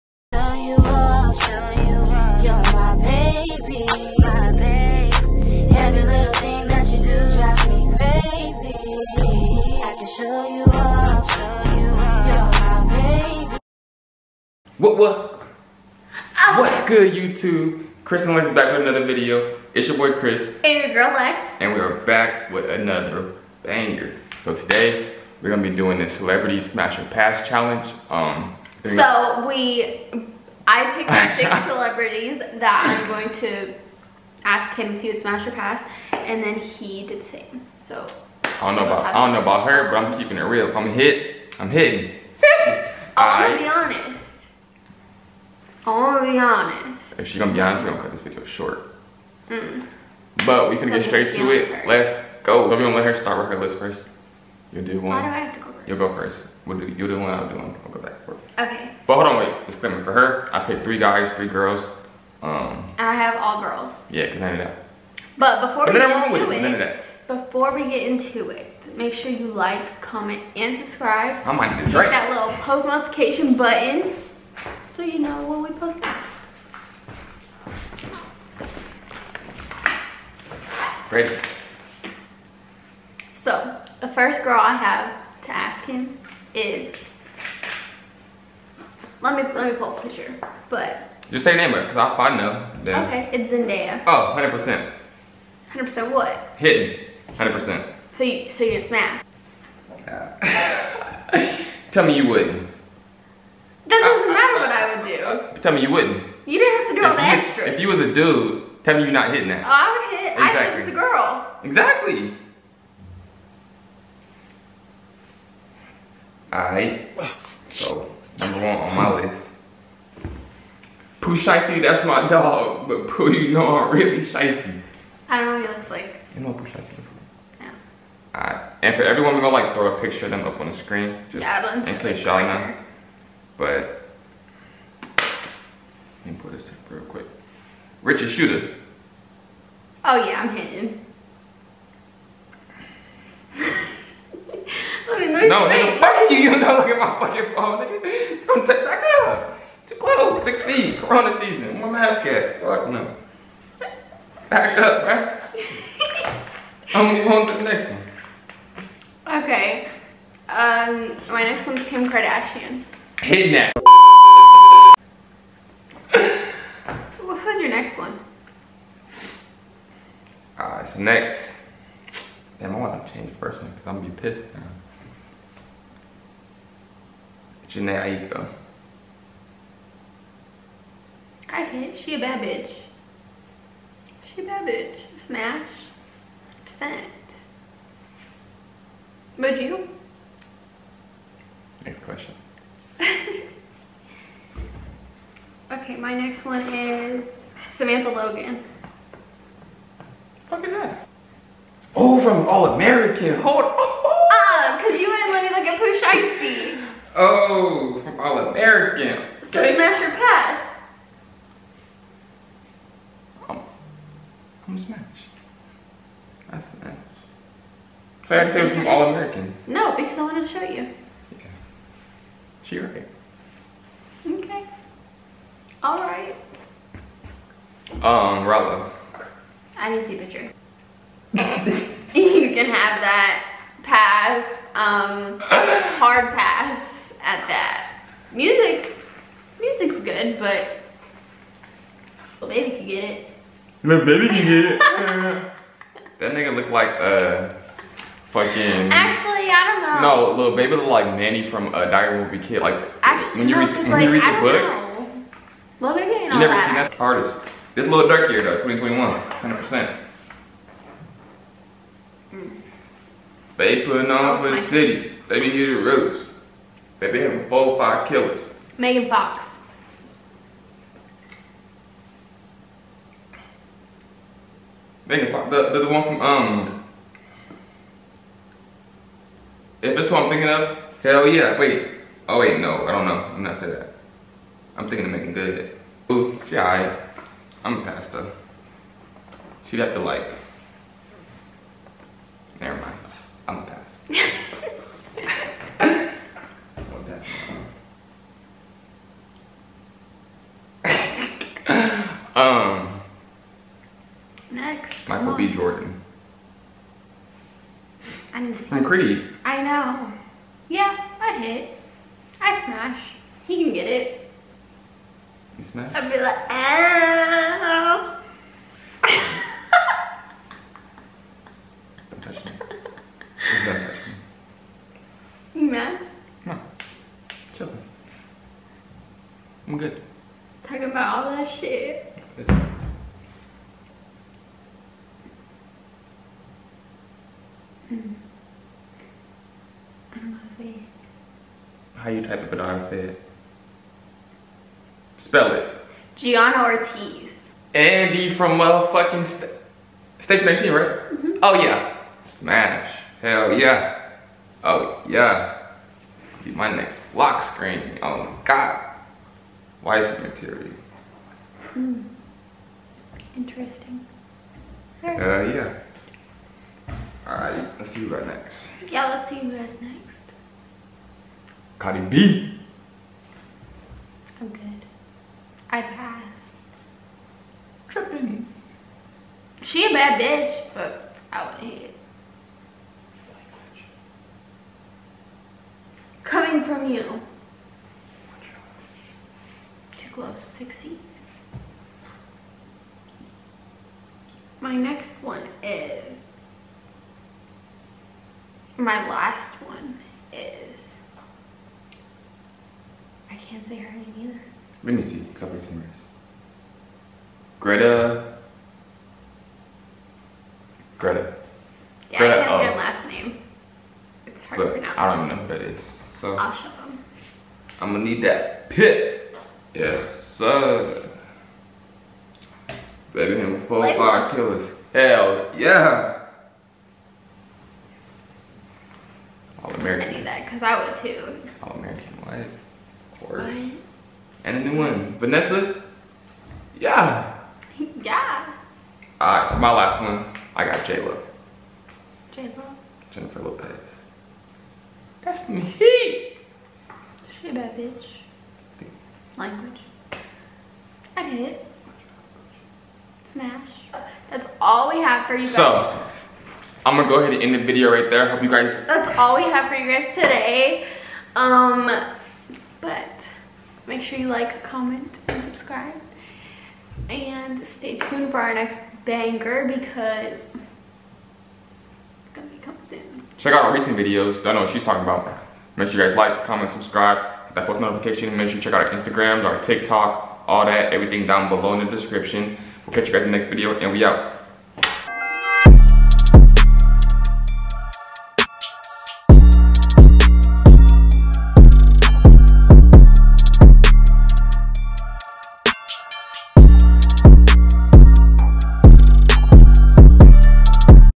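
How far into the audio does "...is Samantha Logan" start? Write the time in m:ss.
3:16.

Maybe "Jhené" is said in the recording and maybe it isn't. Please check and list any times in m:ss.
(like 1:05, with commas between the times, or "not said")
2:57.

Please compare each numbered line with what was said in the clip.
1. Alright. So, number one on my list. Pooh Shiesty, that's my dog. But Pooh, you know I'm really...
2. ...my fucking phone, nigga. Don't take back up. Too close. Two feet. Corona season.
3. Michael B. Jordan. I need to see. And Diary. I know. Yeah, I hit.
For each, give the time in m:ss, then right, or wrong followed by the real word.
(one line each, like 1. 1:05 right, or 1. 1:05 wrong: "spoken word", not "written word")
1. 1:56 right
2. 2:26 wrong: "Six", not "Two"
3. 5:05 wrong: "Creed", not "Diary".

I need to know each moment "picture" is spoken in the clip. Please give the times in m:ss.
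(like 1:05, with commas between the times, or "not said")
1:30, 2:10, 3:50.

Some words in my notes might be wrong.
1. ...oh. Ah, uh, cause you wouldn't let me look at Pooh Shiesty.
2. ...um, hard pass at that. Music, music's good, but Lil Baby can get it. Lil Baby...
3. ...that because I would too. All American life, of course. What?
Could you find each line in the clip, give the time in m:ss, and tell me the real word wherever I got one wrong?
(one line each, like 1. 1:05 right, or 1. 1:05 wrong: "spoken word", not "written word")
1. 3:24 right
2. 3:54 right
3. 7:10 right.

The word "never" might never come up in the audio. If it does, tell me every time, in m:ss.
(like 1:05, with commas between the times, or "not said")
4:16, 4:52.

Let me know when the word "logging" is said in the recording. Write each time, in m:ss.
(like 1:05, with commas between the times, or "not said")
not said.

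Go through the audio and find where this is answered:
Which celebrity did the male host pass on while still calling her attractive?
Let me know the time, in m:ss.
6:11.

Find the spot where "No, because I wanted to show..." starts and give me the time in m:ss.
3:39.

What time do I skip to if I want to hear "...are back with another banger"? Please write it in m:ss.
0:21.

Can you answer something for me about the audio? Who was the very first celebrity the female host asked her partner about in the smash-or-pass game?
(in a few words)
Zendaya.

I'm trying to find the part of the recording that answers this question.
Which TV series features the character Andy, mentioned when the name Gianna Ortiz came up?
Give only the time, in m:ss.
5:50.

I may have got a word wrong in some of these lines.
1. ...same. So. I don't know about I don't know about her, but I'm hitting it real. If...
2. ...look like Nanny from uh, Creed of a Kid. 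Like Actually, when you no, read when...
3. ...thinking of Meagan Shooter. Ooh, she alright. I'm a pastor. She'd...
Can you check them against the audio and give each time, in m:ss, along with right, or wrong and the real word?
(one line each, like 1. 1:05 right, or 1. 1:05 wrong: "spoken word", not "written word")
1. 0:37 wrong: "keeping", not "hitting"
2. 4:10 wrong: "Diary", not "Creed"
3. 4:44 wrong: "Good", not "Shooter".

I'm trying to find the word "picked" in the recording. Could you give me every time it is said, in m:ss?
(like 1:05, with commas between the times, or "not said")
0:30, 1:00.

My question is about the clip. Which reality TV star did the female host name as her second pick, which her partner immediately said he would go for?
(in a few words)
Kim Kardashian.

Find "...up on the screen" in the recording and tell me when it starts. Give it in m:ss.
2:10.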